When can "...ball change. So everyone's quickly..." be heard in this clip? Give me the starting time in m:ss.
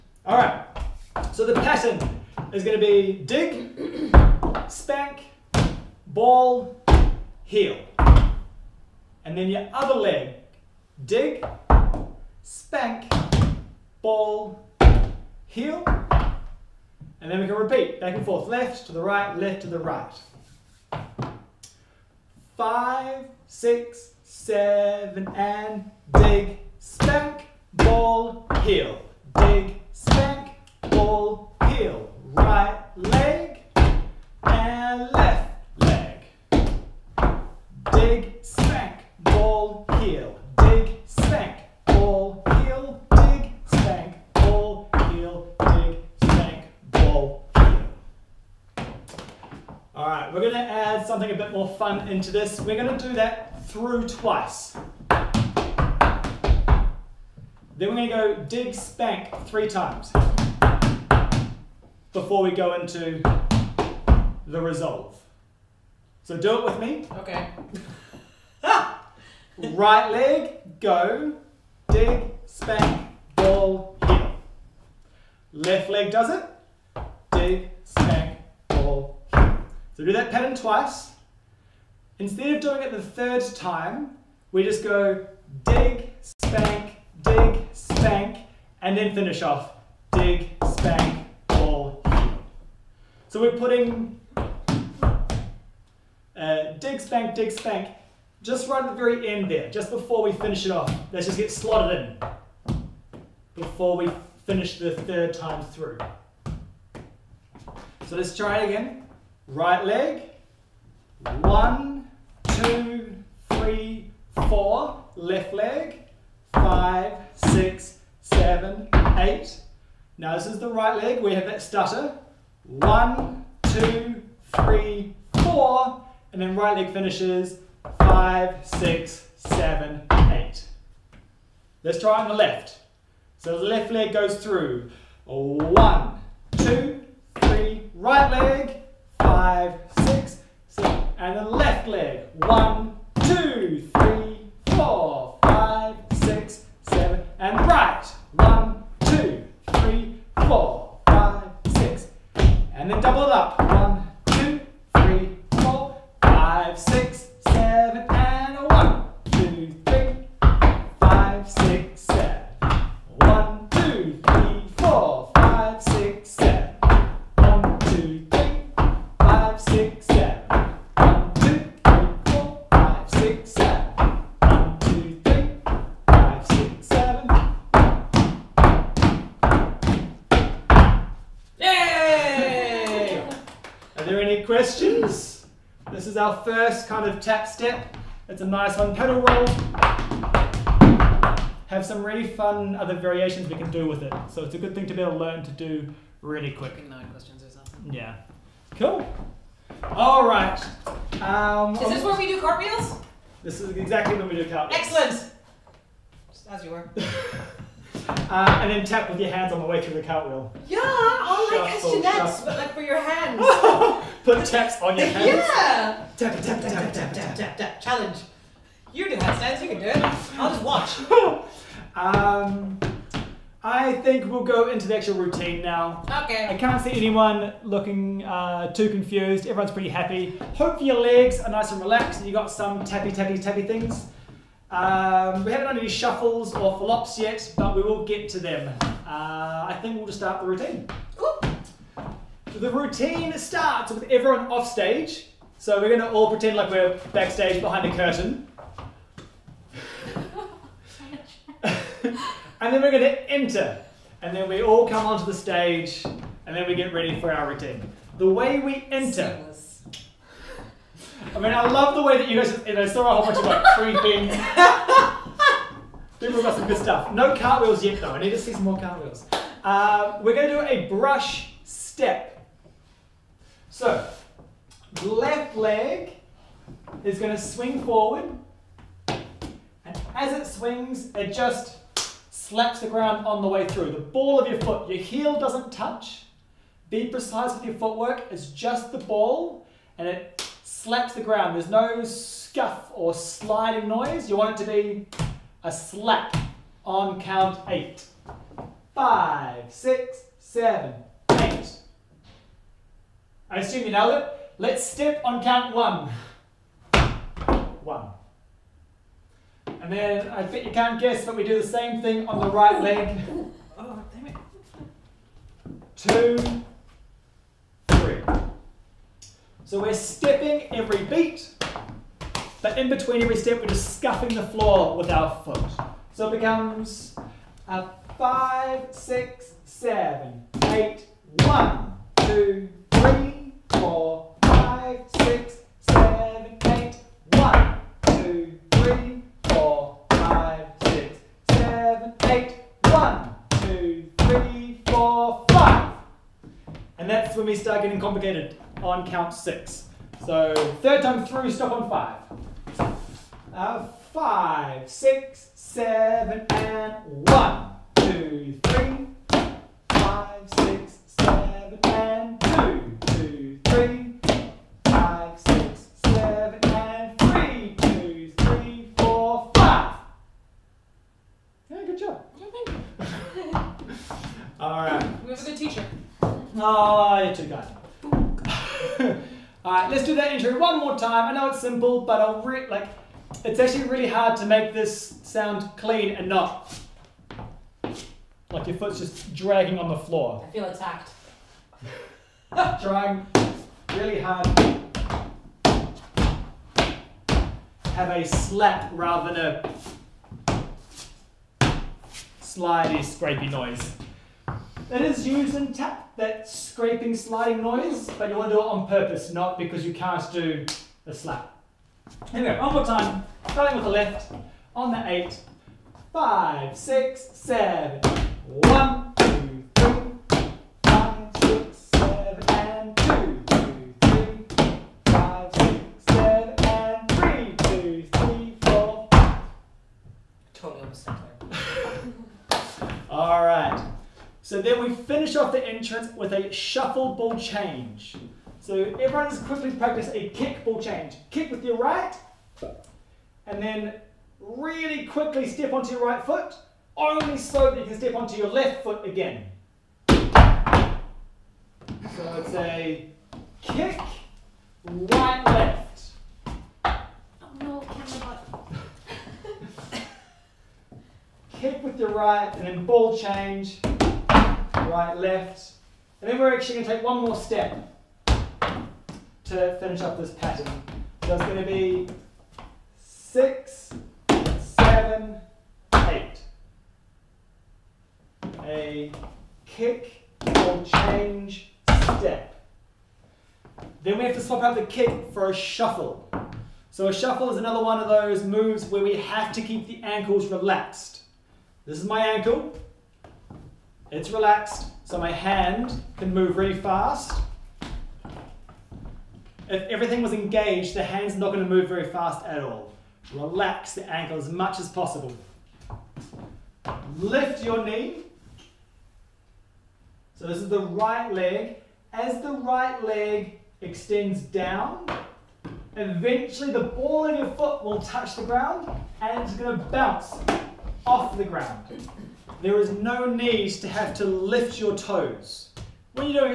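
7:17.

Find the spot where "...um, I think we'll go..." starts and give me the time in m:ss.
3:41.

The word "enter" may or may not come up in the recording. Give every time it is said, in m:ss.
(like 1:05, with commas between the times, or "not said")
4:13, 4:18.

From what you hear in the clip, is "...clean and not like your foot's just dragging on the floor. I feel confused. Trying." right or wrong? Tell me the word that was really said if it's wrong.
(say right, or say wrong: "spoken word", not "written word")
wrong: "attacked", not "confused".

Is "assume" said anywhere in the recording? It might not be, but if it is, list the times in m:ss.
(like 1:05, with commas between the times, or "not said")
5:03.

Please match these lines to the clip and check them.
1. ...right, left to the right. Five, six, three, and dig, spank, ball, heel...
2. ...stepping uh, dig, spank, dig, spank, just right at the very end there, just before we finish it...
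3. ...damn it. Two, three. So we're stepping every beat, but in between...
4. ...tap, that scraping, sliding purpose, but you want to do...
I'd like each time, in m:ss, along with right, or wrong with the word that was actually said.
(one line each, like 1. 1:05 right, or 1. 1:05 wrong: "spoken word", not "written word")
1. 0:19 wrong: "seven", not "three"
2. 1:33 wrong: "putting", not "stepping"
3. 5:14 right
4. 6:45 wrong: "noise", not "purpose".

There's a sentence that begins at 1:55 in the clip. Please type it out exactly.
Left leg, five, six, seven, eight.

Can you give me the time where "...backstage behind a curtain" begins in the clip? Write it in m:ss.
4:07.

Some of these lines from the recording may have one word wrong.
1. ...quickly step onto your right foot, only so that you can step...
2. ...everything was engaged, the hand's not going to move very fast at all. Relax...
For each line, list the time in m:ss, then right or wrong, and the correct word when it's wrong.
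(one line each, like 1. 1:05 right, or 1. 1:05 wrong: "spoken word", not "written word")
1. 7:25 right
2. 8:19 right.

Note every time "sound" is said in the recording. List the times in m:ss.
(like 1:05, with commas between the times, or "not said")
6:25.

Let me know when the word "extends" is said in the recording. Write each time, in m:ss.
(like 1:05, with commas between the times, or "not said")
8:33.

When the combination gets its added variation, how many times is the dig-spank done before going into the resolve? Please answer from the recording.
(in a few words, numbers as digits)
3.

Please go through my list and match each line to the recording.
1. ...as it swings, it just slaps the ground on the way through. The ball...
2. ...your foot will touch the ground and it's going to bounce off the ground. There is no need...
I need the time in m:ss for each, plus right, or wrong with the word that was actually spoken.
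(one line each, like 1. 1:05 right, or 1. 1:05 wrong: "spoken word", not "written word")
1. 4:40 right
2. 8:37 right.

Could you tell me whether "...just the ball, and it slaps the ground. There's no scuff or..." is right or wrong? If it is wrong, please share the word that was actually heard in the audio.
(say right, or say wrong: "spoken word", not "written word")
right.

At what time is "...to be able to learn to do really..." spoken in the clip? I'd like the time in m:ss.
3:14.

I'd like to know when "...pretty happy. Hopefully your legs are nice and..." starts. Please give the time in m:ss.
3:49.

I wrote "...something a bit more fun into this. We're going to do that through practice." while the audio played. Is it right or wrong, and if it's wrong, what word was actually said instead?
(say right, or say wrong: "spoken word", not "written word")
wrong: "twice", not "practice".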